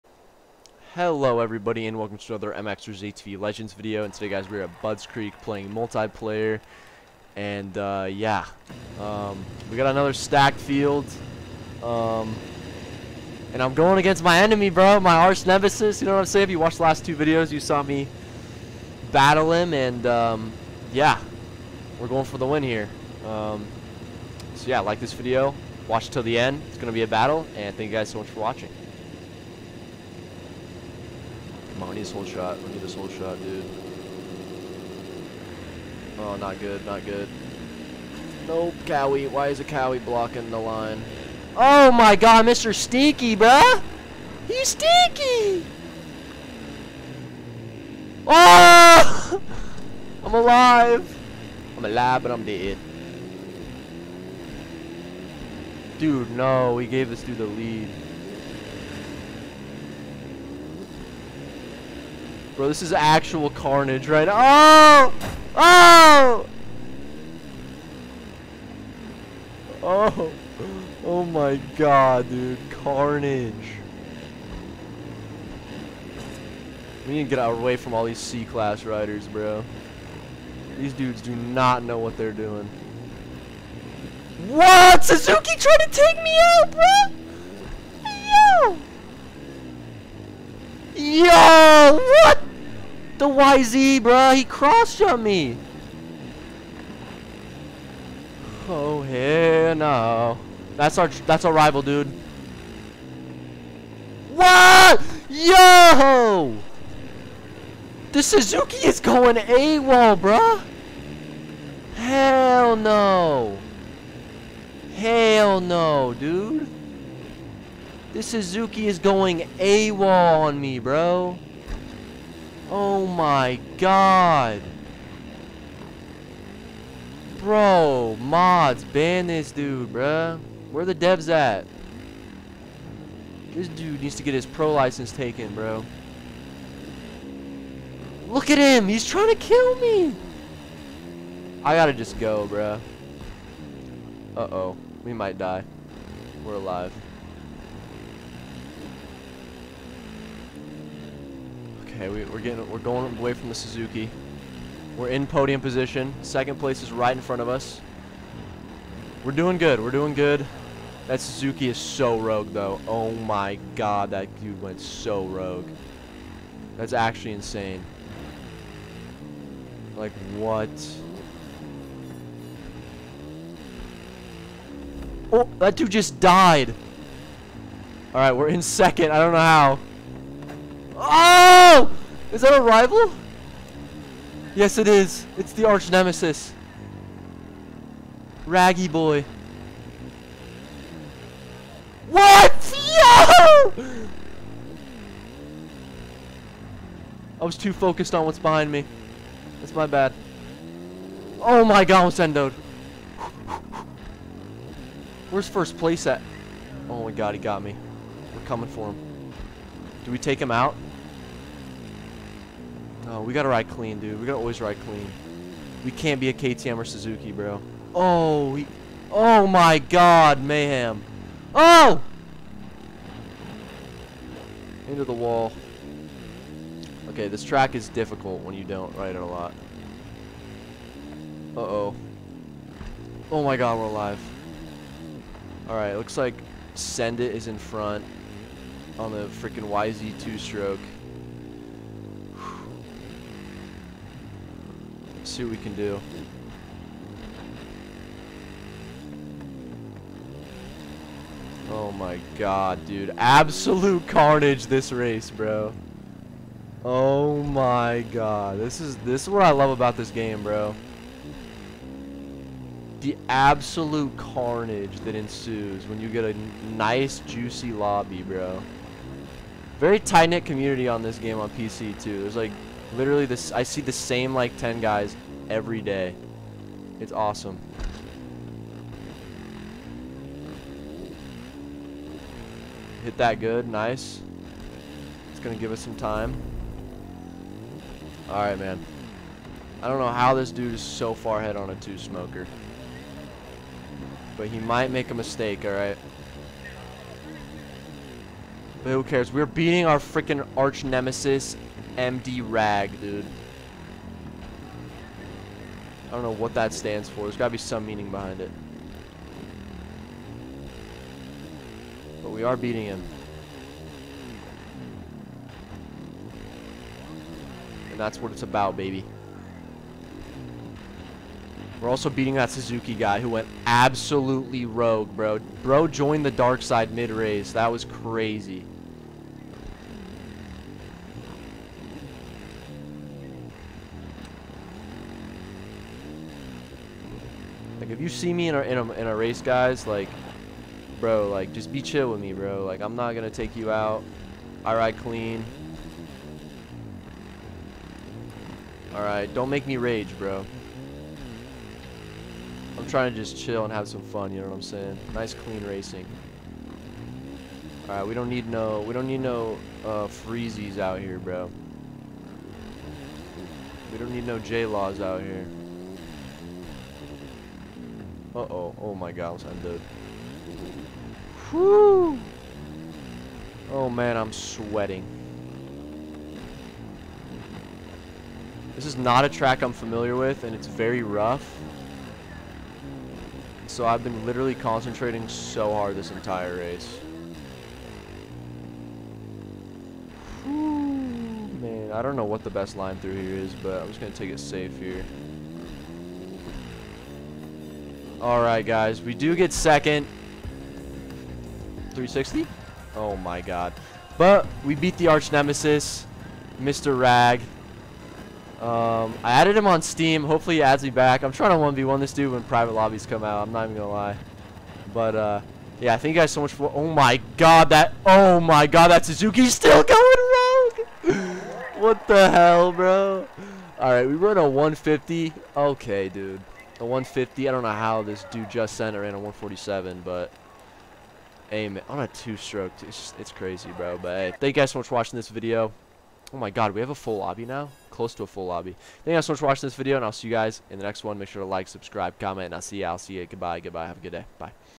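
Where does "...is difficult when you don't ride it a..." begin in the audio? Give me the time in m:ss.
3:47.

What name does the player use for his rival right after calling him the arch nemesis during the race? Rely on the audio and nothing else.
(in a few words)
Raggy boy.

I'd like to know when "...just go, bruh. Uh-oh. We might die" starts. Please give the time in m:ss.
2:21.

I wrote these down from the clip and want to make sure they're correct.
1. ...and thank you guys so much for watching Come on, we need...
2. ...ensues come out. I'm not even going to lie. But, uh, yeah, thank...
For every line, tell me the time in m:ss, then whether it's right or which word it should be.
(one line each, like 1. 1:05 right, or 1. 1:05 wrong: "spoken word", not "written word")
1. 0:27 right
2. 6:52 wrong: "lobbies", not "ensues".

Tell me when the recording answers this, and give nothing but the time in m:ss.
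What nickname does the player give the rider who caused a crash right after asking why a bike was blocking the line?
0:42.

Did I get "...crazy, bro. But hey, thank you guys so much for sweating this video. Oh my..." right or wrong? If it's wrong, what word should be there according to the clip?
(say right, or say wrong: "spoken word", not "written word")
wrong: "watching", not "sweating".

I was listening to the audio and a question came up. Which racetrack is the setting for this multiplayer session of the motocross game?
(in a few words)
Buds Creek.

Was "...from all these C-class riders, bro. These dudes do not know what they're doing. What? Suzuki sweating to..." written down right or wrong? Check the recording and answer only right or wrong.
wrong.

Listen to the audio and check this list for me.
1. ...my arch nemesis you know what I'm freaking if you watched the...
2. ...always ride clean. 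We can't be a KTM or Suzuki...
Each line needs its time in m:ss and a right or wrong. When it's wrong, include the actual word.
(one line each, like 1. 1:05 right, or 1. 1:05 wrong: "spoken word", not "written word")
1. 0:14 wrong: "saying", not "freaking"
2. 3:34 right.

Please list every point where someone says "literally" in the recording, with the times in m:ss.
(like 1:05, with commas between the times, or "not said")
4:32, 6:24.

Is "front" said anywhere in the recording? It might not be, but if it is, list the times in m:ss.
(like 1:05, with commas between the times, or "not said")
2:37, 3:57.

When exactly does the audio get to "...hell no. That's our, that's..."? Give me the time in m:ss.
1:39.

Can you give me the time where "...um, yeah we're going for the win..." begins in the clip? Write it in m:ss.
0:20.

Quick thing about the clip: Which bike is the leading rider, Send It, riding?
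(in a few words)
YZ two-stroke.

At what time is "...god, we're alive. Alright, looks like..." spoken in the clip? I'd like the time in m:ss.
3:53.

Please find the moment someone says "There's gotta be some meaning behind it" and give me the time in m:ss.
5:07.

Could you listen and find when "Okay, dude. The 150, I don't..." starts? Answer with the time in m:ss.
7:05.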